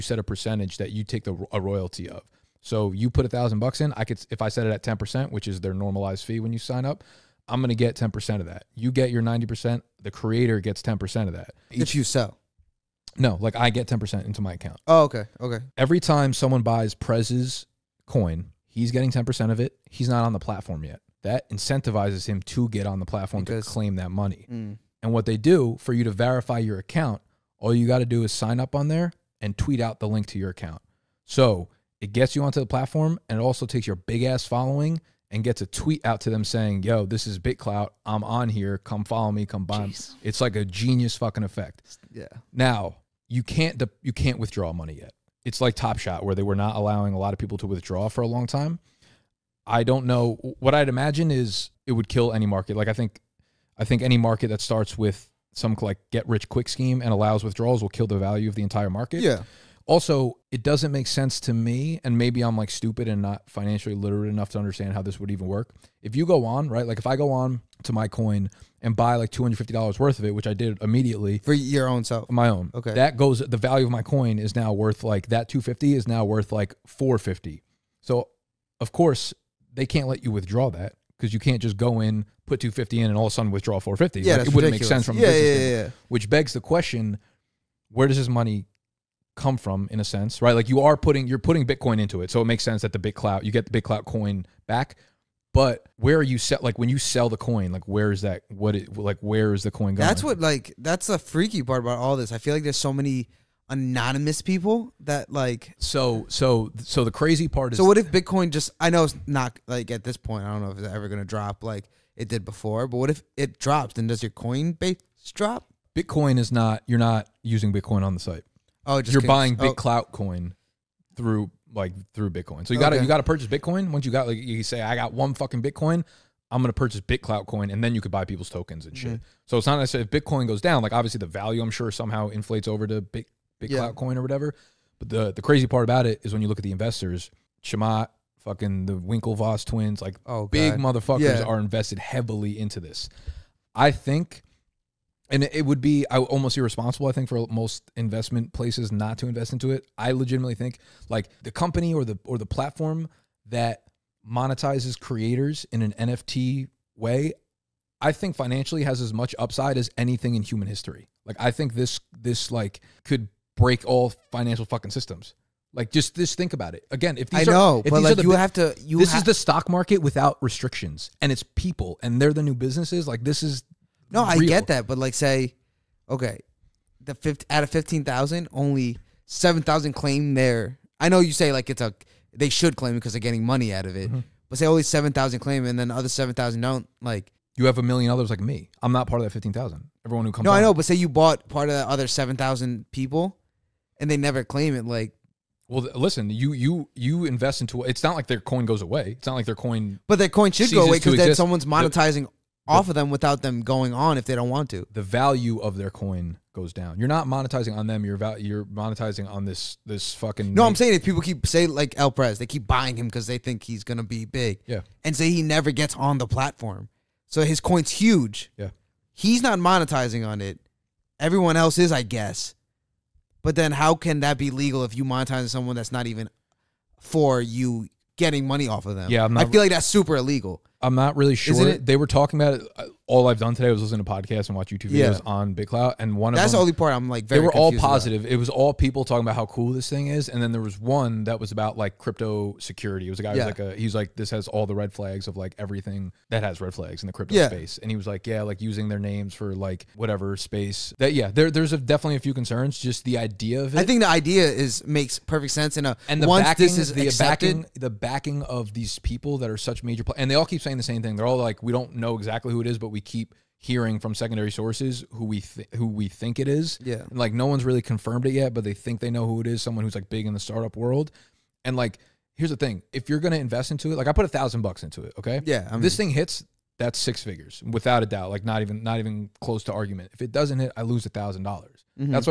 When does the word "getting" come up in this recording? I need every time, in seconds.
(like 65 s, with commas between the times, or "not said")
18 s, 183 s, 228 s.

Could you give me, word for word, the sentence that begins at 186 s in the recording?
Like you have a million others like me.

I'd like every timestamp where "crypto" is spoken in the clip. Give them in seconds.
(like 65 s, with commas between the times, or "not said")
241 s, 247 s.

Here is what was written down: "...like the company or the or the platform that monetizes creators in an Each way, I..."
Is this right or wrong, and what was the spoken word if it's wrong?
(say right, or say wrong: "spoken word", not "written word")
wrong: "NFT", not "Each".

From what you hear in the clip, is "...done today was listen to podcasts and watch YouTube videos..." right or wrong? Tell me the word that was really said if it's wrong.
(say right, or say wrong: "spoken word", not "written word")
right.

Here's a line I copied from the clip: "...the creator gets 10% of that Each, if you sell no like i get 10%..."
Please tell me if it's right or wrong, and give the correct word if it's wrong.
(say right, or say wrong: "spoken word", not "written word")
right.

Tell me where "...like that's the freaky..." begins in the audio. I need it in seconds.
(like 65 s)
100 s.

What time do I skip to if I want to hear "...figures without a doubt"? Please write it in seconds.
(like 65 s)
277 s.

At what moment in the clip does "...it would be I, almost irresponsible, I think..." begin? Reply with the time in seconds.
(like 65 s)
145 s.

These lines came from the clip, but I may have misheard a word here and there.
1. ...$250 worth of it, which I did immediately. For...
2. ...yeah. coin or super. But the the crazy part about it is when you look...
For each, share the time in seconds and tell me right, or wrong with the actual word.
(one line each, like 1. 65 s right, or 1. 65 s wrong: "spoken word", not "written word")
1. 69 s right
2. 133 s wrong: "whatever", not "super".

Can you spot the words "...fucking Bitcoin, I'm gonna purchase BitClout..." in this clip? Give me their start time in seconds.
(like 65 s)
125 s.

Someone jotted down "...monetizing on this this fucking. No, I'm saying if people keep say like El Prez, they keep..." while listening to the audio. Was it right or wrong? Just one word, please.
right.